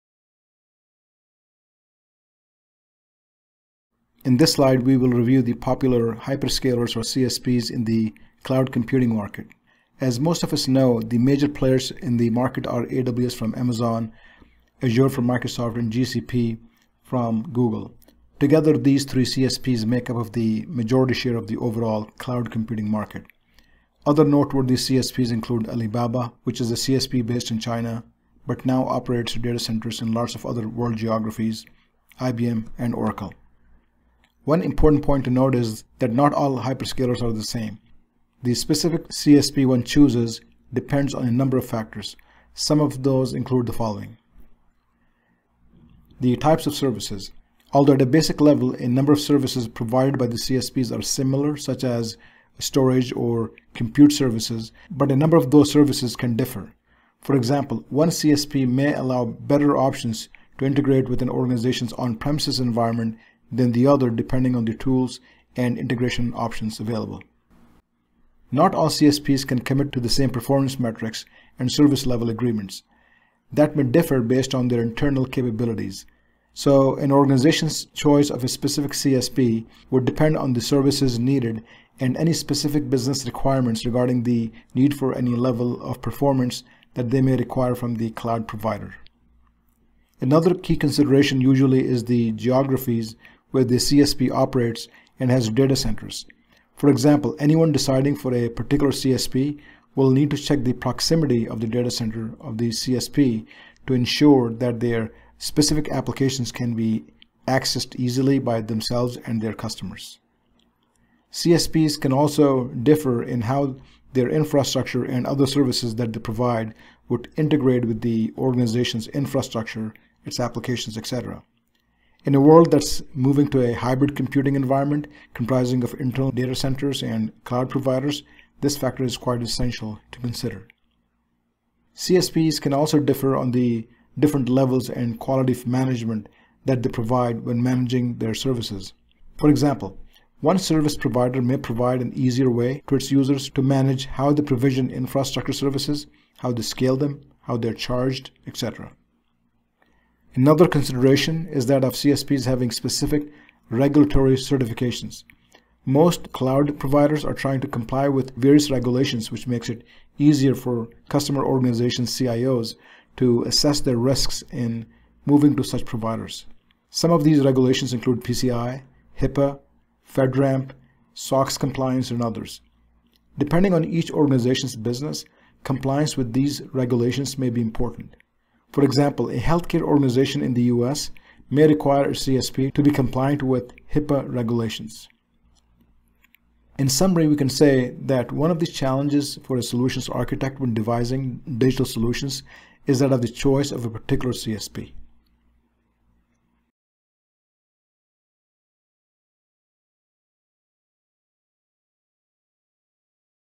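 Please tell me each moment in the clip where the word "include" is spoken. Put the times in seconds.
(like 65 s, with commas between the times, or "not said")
25 s, 43 s, 167 s.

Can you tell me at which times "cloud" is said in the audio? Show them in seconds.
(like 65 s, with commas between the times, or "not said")
8 s, 22 s, 88 s, 127 s, 156 s.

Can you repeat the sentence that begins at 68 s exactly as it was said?
Not all CSPs can commit to the same performance metrics and service level agreements.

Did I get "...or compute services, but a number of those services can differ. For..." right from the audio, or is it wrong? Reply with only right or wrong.
right.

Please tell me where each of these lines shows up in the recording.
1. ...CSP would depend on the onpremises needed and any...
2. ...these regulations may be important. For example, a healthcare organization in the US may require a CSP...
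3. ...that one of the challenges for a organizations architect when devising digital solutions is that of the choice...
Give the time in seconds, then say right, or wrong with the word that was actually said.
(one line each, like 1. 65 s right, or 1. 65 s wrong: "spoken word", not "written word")
1. 78 s wrong: "services", not "onpremises"
2. 176 s right
3. 188 s wrong: "solutions", not "organizations".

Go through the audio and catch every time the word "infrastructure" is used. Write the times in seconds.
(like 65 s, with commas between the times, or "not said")
114 s, 119 s, 144 s.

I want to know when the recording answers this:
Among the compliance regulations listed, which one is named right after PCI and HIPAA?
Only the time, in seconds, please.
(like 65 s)
170 s.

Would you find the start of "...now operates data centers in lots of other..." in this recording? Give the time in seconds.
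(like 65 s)
28 s.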